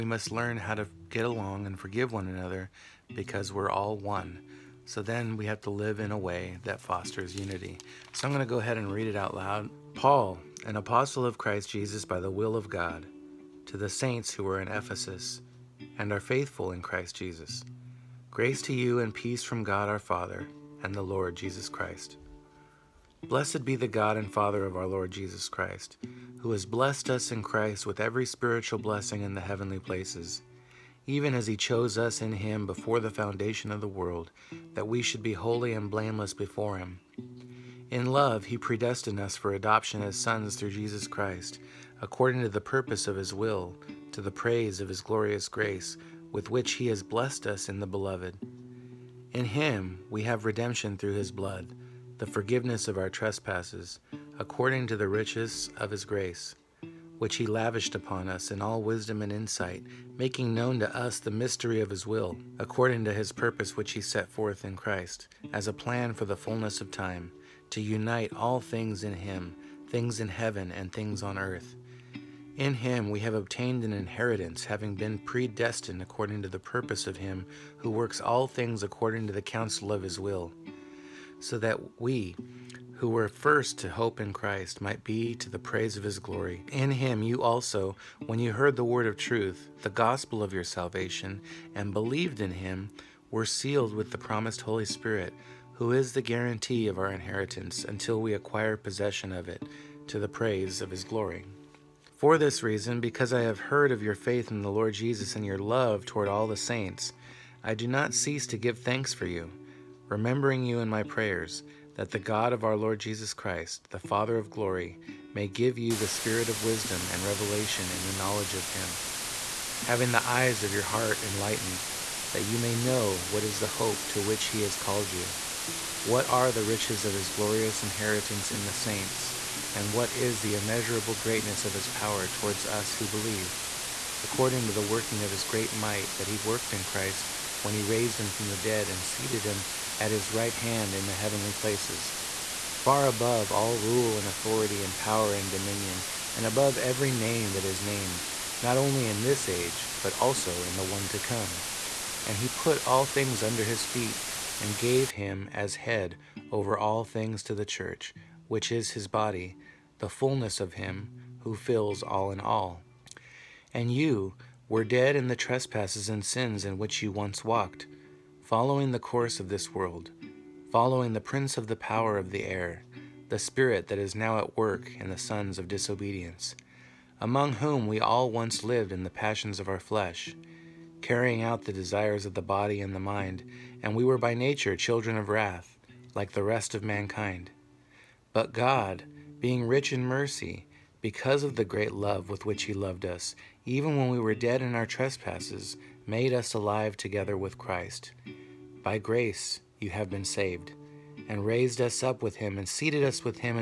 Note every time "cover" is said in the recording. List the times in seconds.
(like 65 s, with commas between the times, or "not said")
not said.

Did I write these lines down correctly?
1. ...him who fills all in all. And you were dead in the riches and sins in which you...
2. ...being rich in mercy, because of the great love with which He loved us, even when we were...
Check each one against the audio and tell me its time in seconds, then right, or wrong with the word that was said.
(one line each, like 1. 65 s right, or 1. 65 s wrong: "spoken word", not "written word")
1. 160 s wrong: "trespasses", not "riches"
2. 189 s right.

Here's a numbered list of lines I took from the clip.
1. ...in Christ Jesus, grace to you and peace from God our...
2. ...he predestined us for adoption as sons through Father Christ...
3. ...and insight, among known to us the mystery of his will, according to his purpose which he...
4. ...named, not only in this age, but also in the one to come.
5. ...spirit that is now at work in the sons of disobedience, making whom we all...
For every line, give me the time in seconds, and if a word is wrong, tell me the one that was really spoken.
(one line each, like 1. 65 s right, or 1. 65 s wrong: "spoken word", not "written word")
1. 16 s right
2. 38 s wrong: "Jesus", not "Father"
3. 59 s wrong: "making", not "among"
4. 147 s right
5. 173 s wrong: "among", not "making".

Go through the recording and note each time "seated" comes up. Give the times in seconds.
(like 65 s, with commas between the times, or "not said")
139 s, 202 s.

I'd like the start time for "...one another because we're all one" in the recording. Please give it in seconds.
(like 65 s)
2 s.